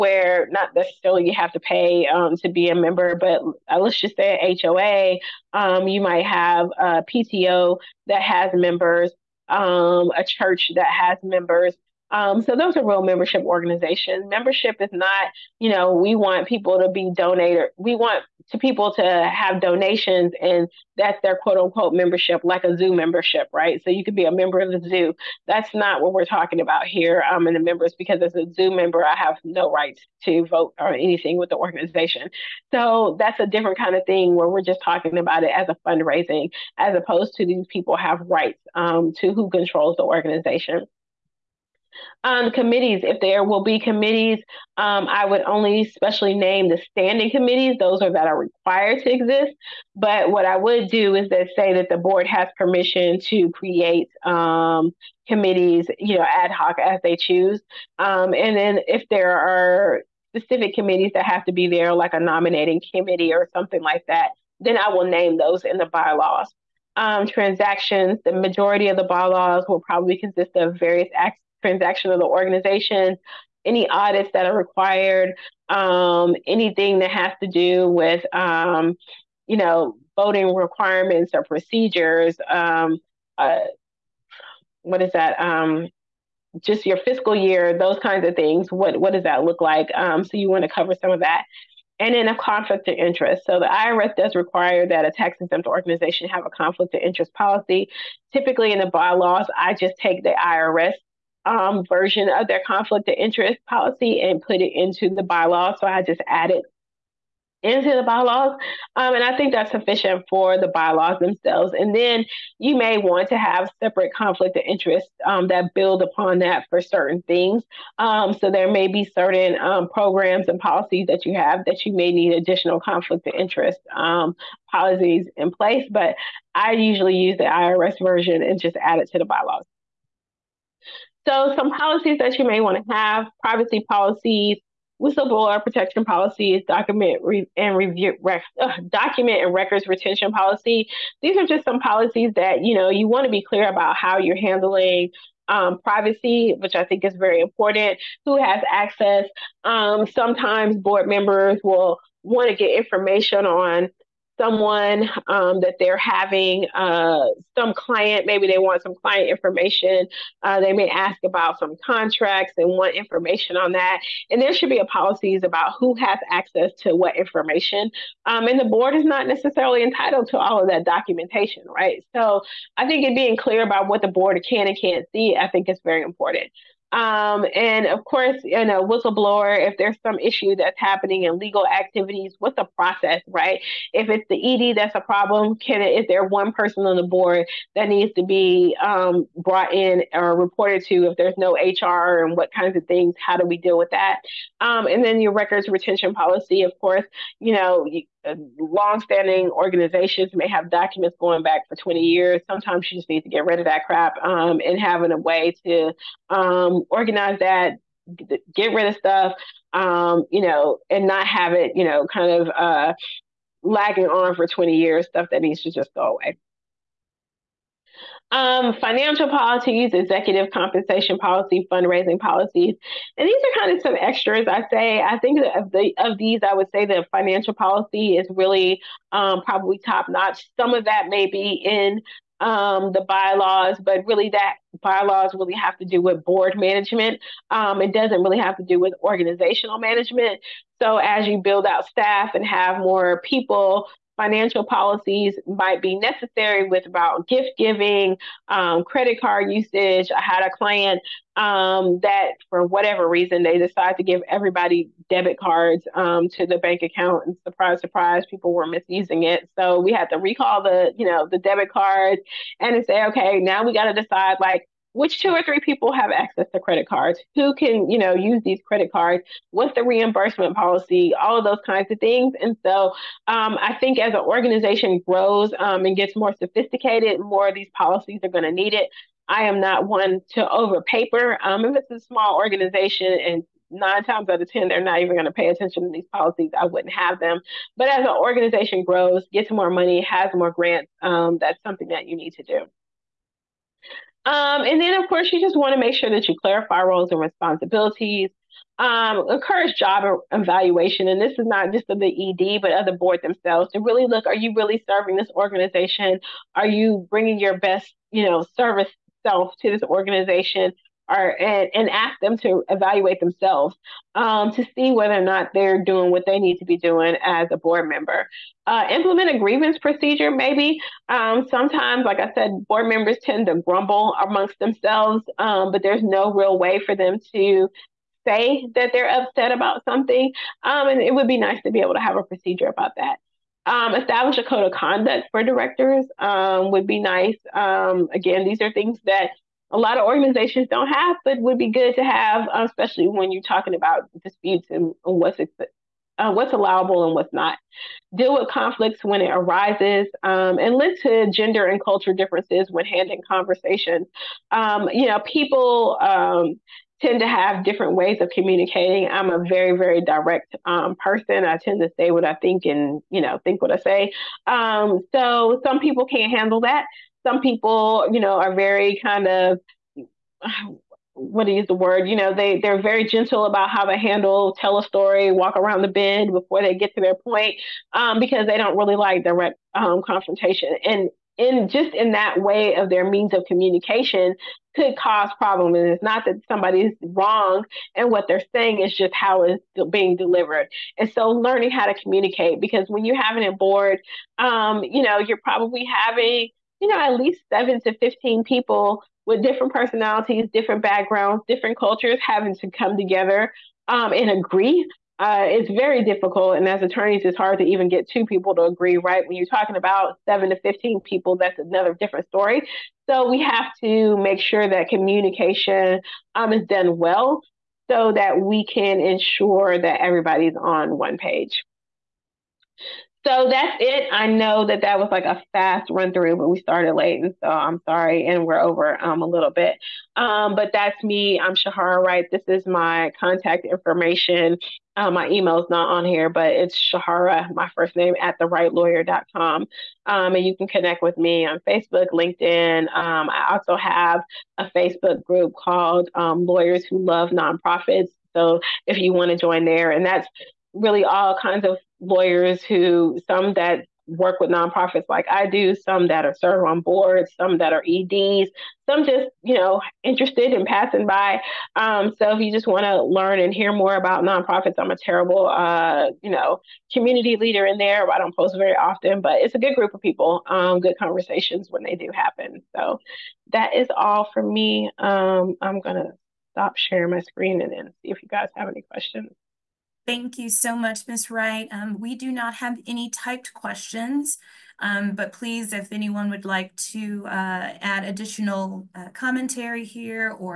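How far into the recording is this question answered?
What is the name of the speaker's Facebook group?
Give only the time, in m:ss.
7:26.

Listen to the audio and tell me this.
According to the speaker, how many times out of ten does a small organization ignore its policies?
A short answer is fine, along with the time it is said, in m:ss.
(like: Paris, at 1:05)
9, at 4:43.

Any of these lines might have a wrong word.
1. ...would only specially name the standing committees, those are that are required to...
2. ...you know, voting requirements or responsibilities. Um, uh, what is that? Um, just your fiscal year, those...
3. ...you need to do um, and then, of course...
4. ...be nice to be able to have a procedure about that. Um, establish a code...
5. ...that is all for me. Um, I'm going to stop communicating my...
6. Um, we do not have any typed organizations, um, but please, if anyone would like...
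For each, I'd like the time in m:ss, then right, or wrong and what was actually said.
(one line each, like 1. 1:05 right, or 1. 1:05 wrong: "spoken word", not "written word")
1. 0:45 right
2. 1:19 wrong: "procedures", not "responsibilities"
3. 4:52 right
4. 5:31 right
5. 7:53 wrong: "sharing", not "communicating"
6. 8:01 wrong: "questions", not "organizations".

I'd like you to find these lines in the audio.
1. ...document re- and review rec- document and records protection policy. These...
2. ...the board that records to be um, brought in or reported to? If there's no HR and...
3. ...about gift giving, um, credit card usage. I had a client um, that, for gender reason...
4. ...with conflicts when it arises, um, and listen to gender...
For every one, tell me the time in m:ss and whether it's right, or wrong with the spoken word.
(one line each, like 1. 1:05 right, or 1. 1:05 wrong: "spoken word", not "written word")
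1. 2:16 wrong: "retention", not "protection"
2. 3:06 wrong: "needs", not "records"
3. 4:06 wrong: "whatever", not "gender"
4. 5:48 right.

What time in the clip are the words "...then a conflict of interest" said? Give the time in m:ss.
1:32.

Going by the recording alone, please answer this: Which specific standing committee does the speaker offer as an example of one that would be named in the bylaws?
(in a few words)
Nominating committee.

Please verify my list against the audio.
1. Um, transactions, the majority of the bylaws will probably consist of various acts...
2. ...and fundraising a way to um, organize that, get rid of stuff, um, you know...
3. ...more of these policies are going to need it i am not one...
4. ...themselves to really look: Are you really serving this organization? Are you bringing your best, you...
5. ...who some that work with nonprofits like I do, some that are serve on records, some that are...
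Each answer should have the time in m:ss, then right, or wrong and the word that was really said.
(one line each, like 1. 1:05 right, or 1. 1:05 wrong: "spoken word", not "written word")
1. 1:06 right
2. 3:24 wrong: "having", not "fundraising"
3. 4:37 right
4. 5:03 right
5. 7:32 wrong: "boards", not "records".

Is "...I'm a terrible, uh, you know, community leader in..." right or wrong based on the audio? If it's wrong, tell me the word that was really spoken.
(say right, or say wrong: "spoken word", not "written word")
right.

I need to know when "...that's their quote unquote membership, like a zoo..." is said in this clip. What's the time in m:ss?
0:20.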